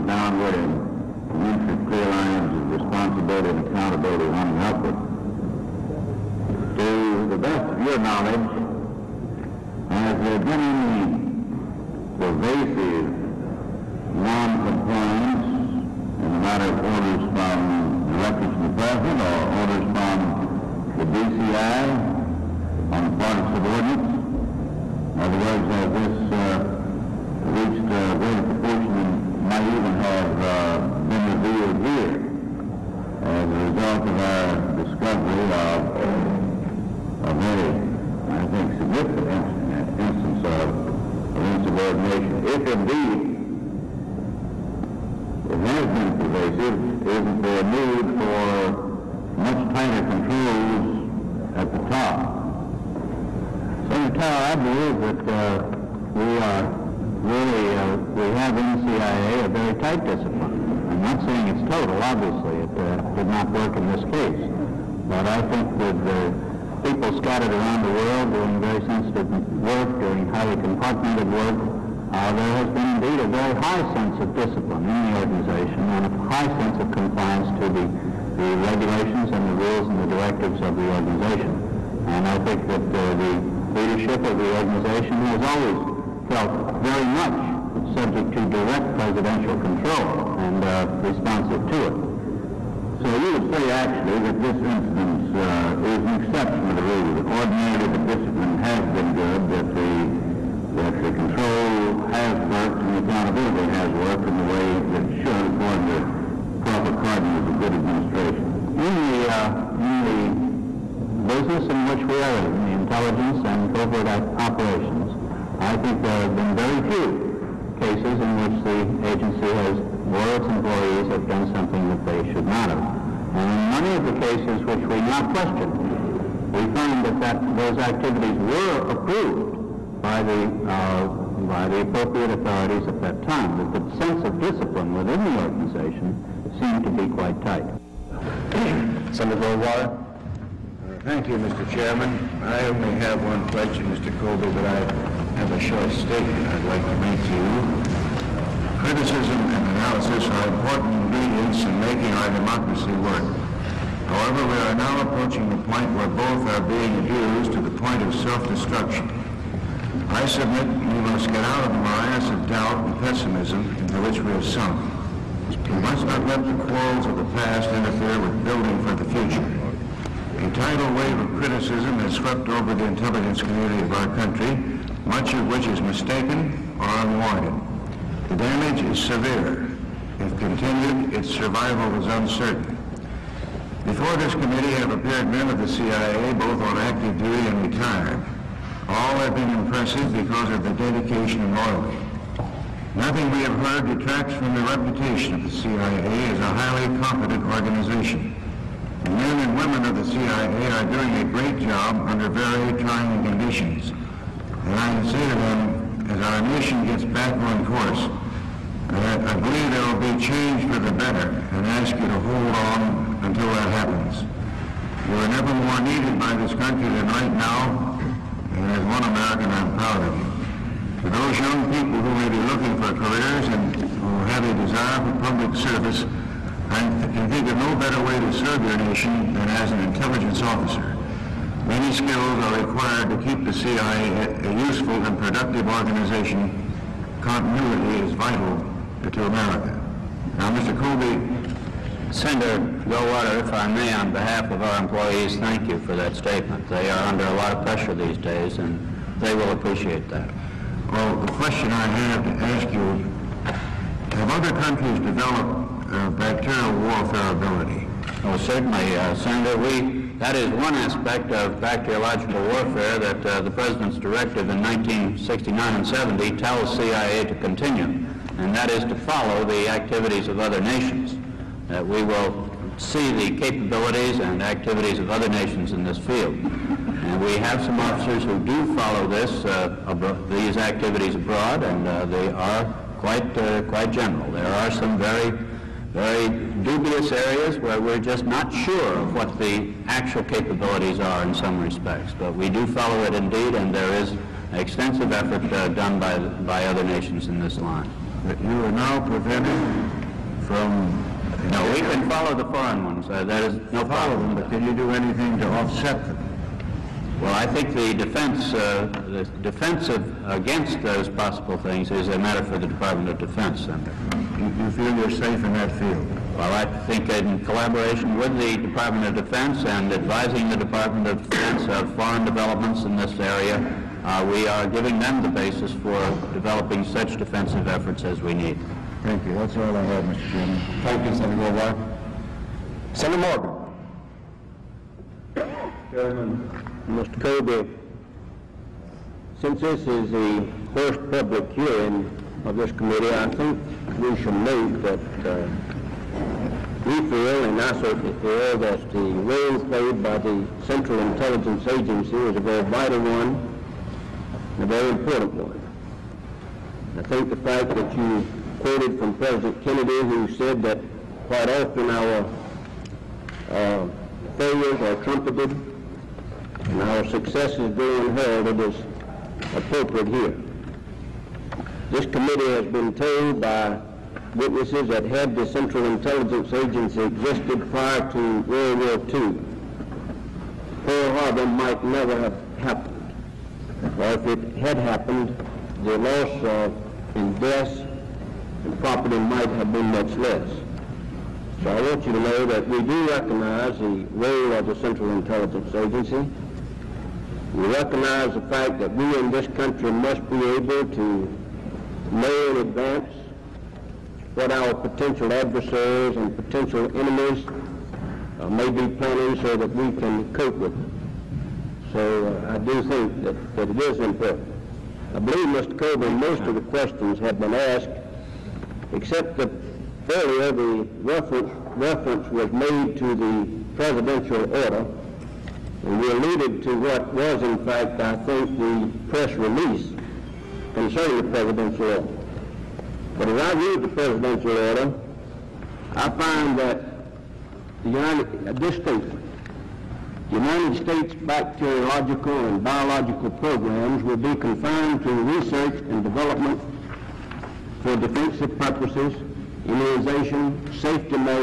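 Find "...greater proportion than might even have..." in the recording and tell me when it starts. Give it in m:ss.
0:28.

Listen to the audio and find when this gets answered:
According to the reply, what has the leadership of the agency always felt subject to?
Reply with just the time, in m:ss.
1:28.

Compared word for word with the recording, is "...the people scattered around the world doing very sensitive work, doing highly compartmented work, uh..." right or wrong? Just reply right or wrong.
right.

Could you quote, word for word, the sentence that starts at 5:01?
No, we can follow the foreign ones.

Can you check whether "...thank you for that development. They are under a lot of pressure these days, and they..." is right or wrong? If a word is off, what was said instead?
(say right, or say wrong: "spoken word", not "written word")
wrong: "statement", not "development".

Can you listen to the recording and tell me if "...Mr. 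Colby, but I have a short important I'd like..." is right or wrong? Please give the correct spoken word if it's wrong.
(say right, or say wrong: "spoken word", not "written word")
wrong: "statement", not "important".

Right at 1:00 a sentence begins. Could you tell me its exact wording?
I'm not saying it's total, obviously.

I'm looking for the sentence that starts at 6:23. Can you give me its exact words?
Or if it had happened, the loss of and deaths and property might have been much less.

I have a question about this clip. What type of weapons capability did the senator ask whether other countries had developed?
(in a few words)
bacterial warfare.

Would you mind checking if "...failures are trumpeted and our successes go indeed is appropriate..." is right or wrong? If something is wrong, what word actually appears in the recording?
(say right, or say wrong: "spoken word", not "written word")
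wrong: "unheralded", not "indeed".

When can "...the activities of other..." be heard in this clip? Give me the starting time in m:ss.
4:29.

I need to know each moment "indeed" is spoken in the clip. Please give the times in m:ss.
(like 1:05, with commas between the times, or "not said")
0:42, 1:12, 4:53.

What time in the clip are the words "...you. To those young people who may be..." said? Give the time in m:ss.
3:40.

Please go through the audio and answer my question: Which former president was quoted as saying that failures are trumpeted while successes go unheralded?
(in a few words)
President Kennedy.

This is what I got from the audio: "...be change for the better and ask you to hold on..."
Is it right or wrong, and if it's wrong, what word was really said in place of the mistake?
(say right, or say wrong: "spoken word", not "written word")
right.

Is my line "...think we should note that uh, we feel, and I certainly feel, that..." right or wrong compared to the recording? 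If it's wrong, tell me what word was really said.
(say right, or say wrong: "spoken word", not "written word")
right.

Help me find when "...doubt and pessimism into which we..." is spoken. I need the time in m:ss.
2:42.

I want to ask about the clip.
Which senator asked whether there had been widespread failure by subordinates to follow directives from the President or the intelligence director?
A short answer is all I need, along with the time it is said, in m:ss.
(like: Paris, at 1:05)
Senator Tower, at 0:53.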